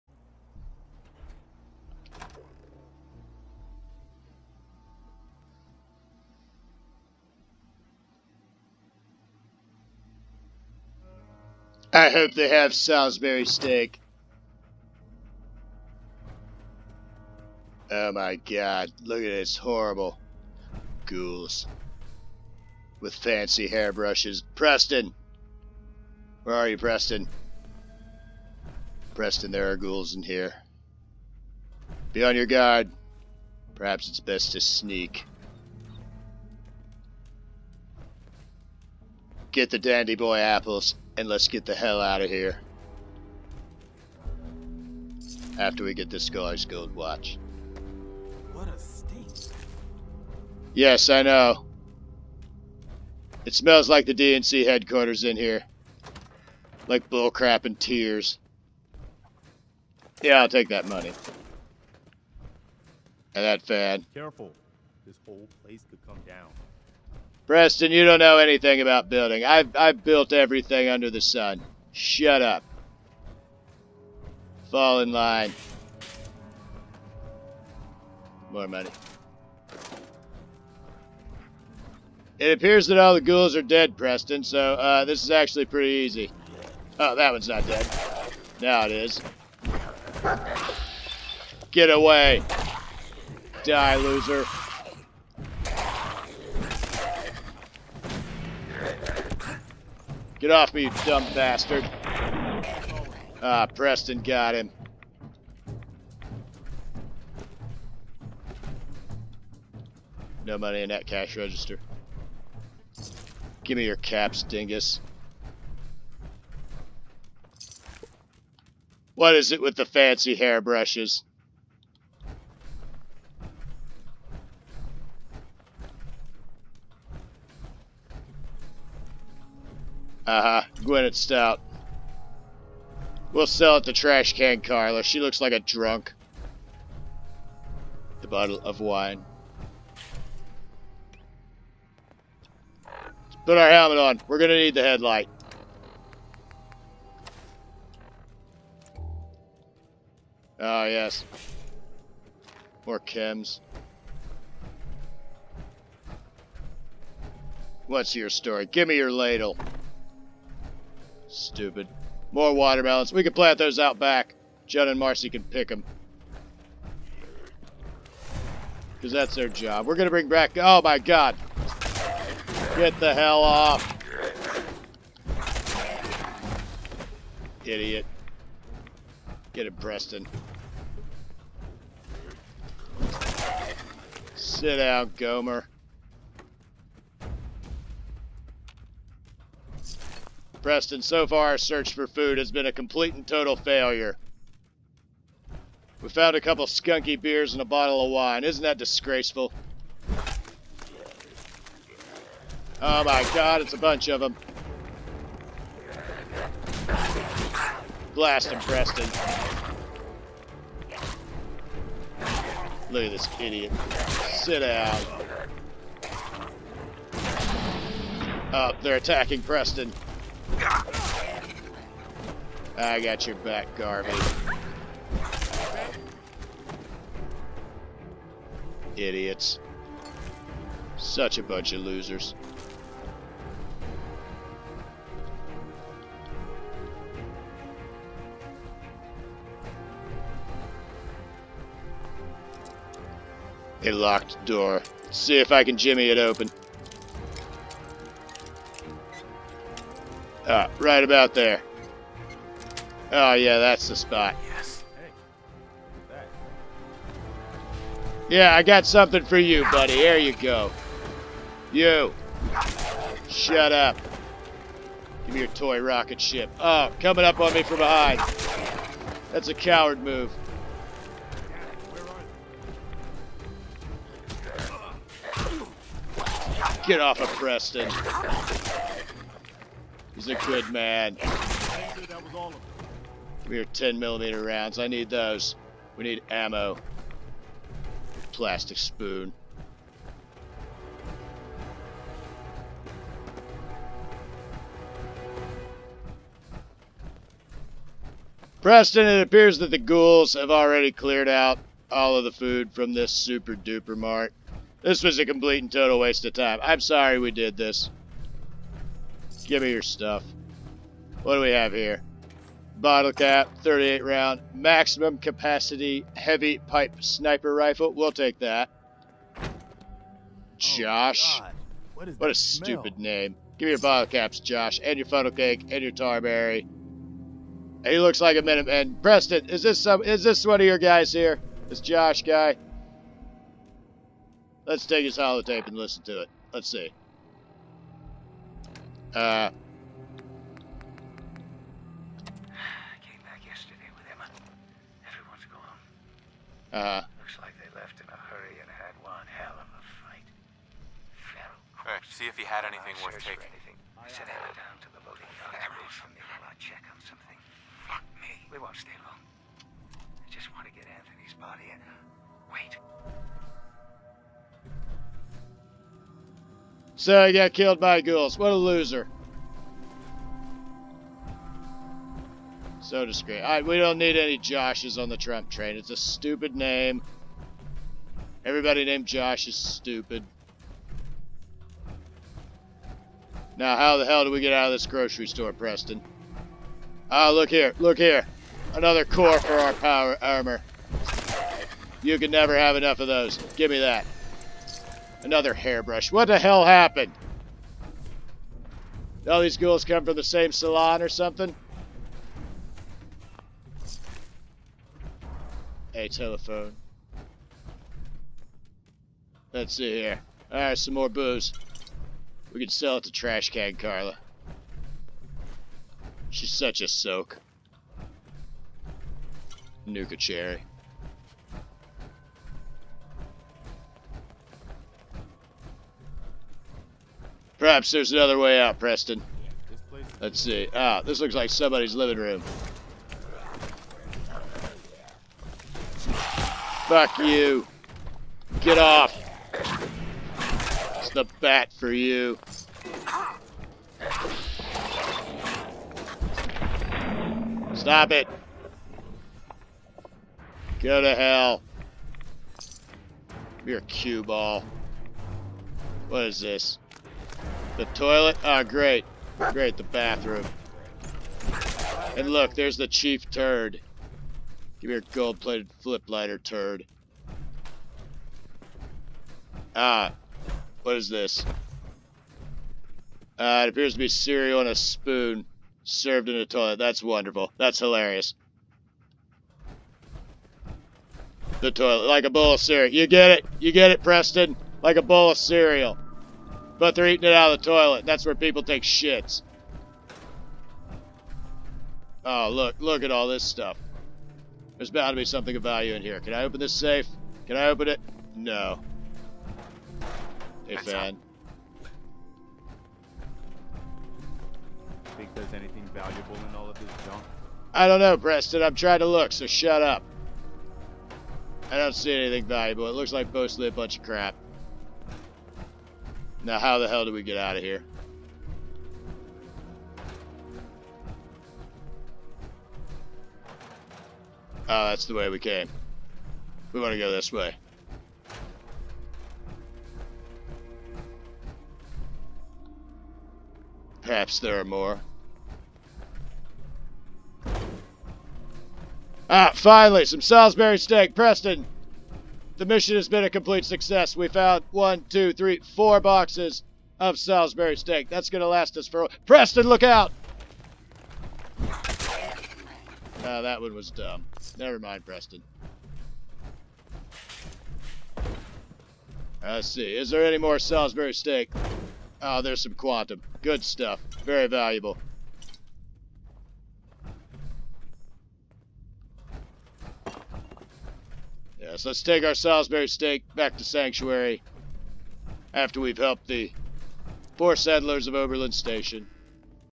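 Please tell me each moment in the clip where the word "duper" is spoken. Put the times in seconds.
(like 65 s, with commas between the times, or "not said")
303 s.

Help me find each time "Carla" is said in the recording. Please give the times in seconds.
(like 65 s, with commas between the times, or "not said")
134 s, 413 s.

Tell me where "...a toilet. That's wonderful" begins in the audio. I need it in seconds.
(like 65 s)
476 s.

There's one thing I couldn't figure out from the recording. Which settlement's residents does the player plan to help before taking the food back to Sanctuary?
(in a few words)
Oberland Station.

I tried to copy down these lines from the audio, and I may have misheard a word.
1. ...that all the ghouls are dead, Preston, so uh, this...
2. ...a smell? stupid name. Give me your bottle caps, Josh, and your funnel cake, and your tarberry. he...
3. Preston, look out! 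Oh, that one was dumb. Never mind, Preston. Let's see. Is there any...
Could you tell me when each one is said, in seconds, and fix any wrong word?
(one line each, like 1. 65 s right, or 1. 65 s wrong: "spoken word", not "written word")
1. 82 s right
2. 322 s right
3. 549 s right.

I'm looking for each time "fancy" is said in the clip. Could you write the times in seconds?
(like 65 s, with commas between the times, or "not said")
23 s, 119 s.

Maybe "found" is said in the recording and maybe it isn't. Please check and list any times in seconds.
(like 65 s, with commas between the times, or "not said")
196 s, 544 s.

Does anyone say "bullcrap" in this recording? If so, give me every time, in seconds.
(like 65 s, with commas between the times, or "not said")
57 s.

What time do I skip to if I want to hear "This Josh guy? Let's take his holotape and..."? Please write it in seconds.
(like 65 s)
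331 s.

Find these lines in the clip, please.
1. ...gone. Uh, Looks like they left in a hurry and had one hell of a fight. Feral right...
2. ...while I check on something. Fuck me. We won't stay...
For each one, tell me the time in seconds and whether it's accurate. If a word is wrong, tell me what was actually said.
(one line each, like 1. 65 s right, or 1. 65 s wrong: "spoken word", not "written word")
1. 345 s right
2. 355 s right.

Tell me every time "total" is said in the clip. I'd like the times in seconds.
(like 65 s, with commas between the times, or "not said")
193 s, 305 s.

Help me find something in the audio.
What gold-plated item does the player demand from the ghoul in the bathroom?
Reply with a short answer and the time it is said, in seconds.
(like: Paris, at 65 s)
flip lighter, at 465 s.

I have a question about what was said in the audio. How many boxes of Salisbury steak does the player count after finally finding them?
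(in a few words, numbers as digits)
4.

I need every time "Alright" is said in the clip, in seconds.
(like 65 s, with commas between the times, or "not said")
373 s, 410 s.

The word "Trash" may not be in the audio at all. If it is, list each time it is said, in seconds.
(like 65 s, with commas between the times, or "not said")
133 s, 413 s.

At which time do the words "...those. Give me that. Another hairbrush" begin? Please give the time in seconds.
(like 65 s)
393 s.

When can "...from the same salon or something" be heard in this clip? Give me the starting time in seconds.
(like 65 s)
400 s.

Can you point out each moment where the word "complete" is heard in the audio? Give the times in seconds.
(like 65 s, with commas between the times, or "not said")
192 s, 305 s, 543 s.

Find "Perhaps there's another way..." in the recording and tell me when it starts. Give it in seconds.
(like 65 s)
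427 s.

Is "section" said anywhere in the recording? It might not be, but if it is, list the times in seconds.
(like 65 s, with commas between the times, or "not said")
not said.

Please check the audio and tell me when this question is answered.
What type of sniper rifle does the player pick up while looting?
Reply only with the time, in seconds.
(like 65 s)
316 s.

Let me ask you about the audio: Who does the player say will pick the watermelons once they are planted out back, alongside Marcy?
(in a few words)
Jun.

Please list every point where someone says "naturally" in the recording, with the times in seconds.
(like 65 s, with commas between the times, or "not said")
not said.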